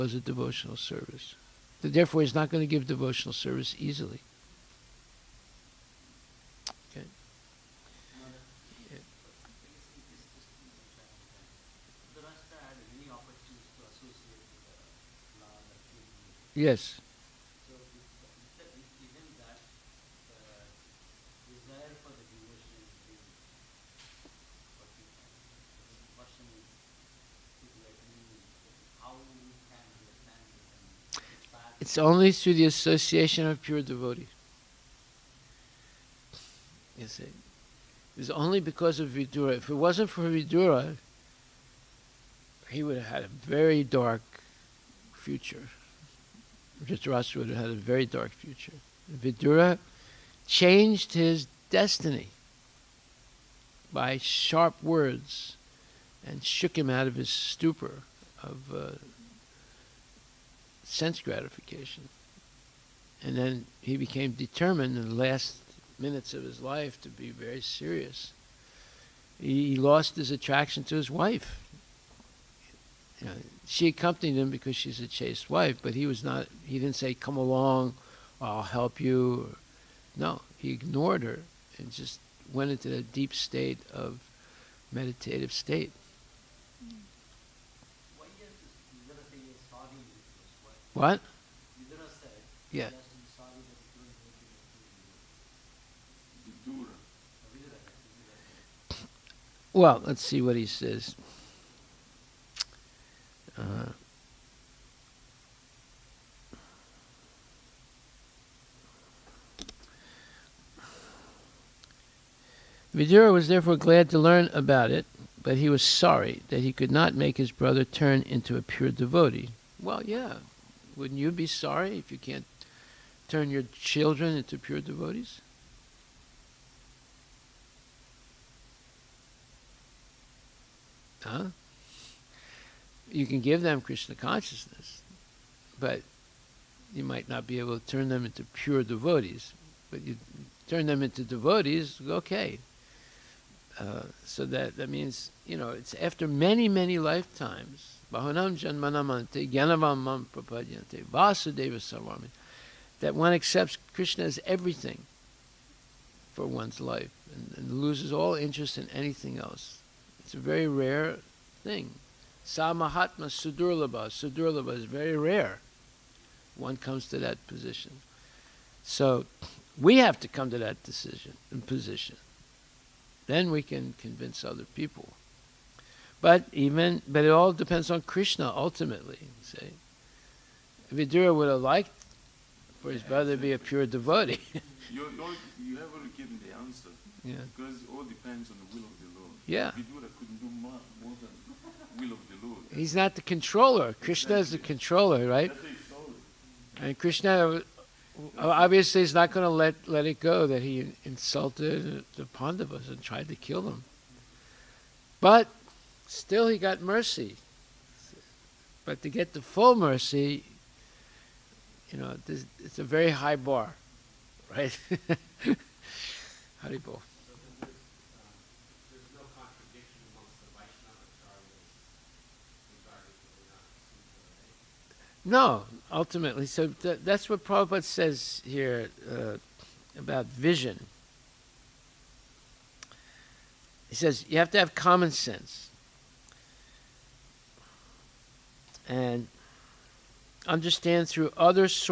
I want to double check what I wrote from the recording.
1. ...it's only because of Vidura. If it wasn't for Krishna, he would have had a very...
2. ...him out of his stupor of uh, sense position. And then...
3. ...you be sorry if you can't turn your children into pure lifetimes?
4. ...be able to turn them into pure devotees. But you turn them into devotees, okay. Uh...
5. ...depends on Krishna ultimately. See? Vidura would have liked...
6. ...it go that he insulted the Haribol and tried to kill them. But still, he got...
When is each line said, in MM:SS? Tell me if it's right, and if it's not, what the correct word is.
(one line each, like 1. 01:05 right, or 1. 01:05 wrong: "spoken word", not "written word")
1. 00:38 wrong: "Vidura", not "Krishna"
2. 00:56 wrong: "gratification", not "position"
3. 02:01 wrong: "devotees", not "lifetimes"
4. 02:17 right
5. 02:57 right
6. 03:20 wrong: "Pandavas", not "Haribol".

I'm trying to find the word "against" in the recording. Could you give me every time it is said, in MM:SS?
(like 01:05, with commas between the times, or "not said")
not said.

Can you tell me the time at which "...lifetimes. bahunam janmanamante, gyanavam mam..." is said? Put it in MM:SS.
02:26.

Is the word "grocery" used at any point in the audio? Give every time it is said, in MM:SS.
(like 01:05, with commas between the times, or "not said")
not said.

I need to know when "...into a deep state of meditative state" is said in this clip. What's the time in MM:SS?
01:22.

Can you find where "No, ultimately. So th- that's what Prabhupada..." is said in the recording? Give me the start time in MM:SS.
03:45.